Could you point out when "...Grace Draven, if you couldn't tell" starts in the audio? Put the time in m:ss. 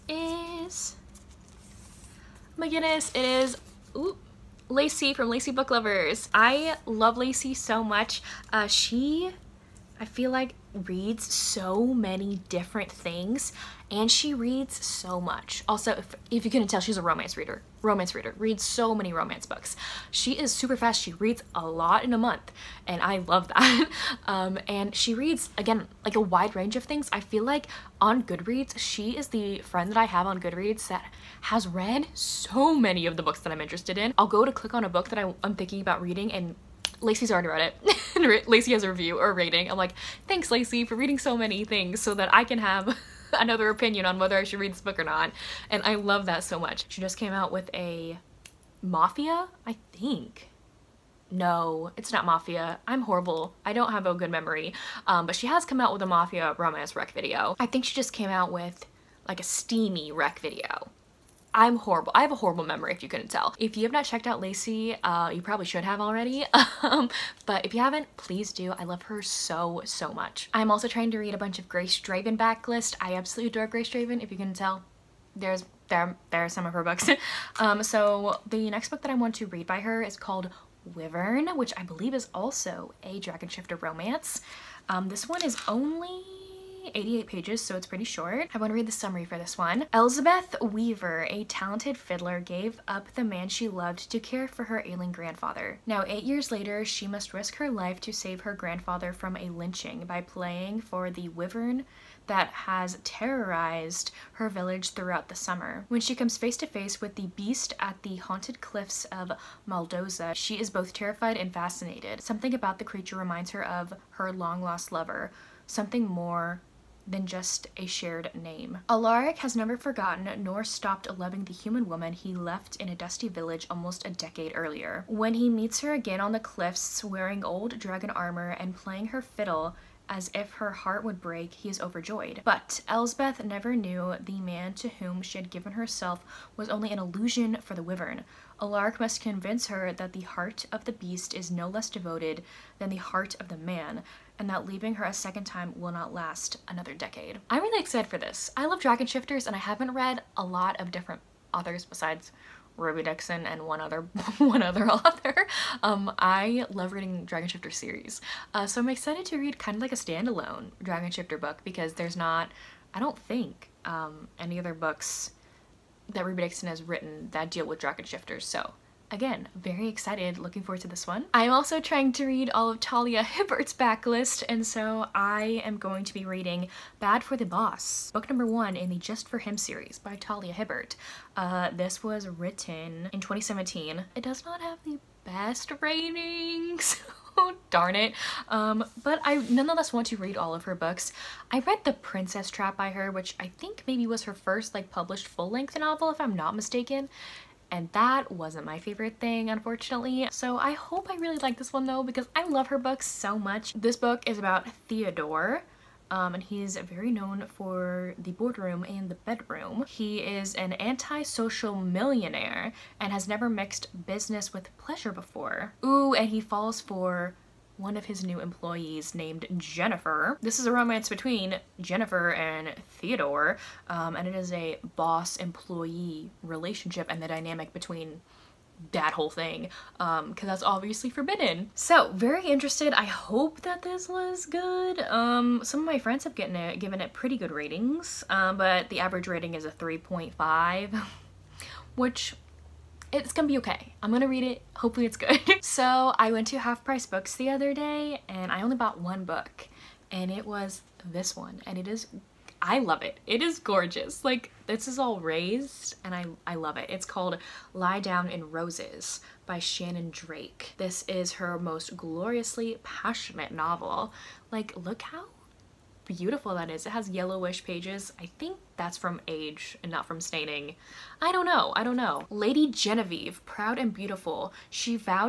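1:13.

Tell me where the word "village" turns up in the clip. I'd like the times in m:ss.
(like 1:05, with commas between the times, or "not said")
1:44, 2:03.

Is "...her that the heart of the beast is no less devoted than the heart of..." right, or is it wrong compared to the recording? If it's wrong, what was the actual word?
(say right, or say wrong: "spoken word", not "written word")
right.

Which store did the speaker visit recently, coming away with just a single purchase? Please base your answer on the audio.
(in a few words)
Half Price Books.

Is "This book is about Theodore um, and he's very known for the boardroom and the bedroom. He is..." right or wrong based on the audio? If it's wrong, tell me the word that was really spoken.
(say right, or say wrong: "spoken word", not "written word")
right.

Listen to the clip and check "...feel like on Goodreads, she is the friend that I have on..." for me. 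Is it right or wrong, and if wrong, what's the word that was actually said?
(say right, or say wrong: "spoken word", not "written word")
right.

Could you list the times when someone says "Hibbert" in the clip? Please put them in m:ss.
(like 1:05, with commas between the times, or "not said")
2:53, 3:00.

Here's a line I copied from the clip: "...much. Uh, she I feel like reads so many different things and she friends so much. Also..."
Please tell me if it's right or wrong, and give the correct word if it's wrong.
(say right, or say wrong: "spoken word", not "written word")
wrong: "reads", not "friends".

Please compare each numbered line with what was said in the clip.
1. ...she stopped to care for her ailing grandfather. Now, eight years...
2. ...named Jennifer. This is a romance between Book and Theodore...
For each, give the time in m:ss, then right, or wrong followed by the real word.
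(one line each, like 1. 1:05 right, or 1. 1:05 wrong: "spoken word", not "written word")
1. 1:33 wrong: "loved", not "stopped"
2. 3:39 wrong: "Jennifer", not "Book".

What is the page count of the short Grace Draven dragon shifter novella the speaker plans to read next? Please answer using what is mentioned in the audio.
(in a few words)
88.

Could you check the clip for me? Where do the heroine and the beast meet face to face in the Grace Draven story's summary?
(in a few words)
cliffs of Maldoza.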